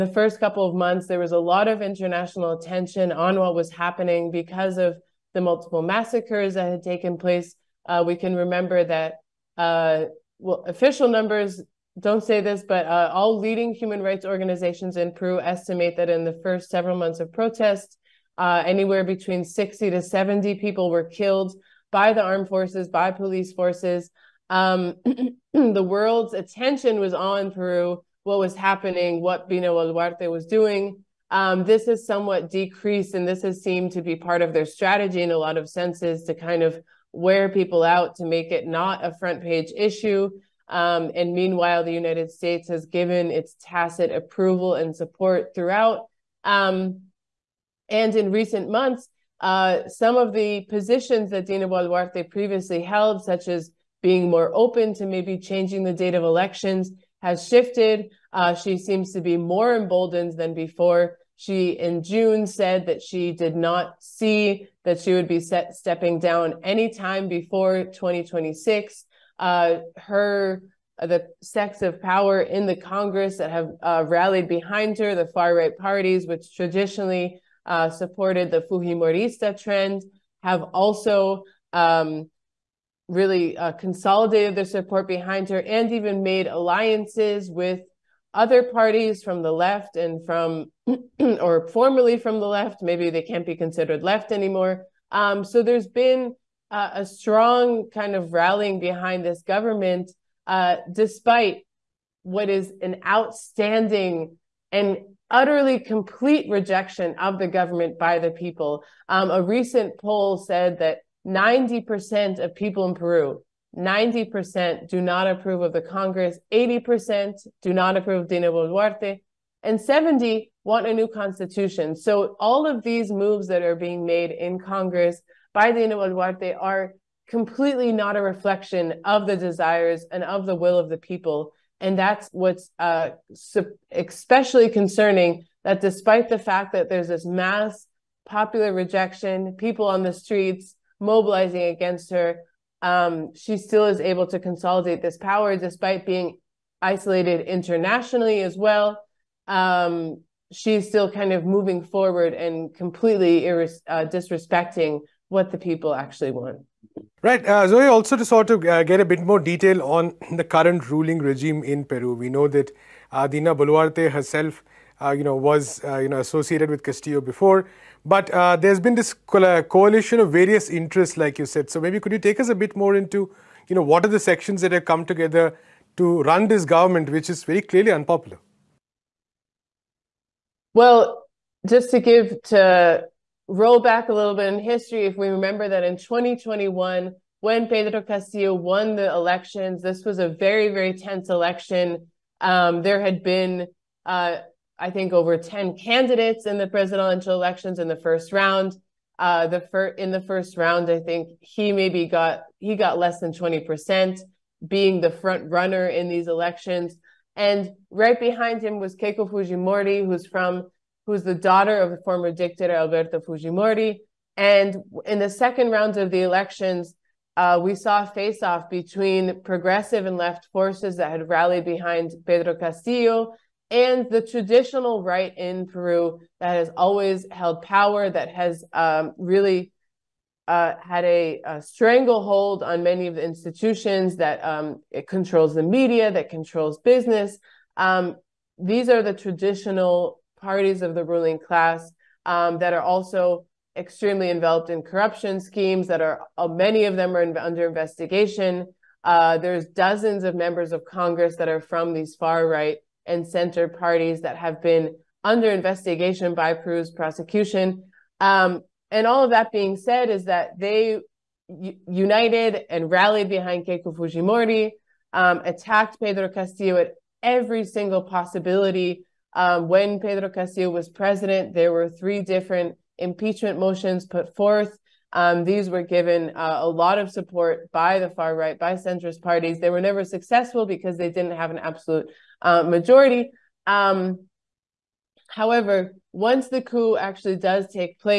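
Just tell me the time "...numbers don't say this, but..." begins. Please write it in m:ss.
0:11.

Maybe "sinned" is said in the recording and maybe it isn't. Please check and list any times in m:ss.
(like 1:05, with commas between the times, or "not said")
not said.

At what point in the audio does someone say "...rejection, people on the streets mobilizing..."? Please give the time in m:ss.
2:18.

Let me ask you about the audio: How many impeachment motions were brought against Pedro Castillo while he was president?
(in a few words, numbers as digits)
3.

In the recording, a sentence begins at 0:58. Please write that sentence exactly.
Uh, she seems to be more emboldened than before.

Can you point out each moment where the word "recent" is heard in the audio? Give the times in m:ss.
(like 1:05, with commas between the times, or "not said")
0:48, 1:49.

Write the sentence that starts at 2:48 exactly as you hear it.
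But uh, there's been this co- uh, coalition of various interests, like you said.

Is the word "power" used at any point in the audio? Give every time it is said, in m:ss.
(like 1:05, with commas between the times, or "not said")
1:12, 2:25, 3:47.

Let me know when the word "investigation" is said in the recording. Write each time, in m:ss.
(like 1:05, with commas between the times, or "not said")
4:07, 4:15.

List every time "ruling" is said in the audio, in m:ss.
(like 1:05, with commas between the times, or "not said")
2:40, 4:01.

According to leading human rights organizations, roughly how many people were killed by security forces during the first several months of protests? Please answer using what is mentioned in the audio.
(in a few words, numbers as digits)
60 to 70.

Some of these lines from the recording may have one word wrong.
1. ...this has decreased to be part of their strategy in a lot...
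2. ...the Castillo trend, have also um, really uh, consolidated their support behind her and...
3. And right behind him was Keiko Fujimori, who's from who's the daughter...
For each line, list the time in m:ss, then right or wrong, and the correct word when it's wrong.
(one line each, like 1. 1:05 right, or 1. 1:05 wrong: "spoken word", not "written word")
1. 0:33 wrong: "seemed", not "decreased"
2. 1:18 wrong: "Fujimorista", not "Castillo"
3. 3:27 right.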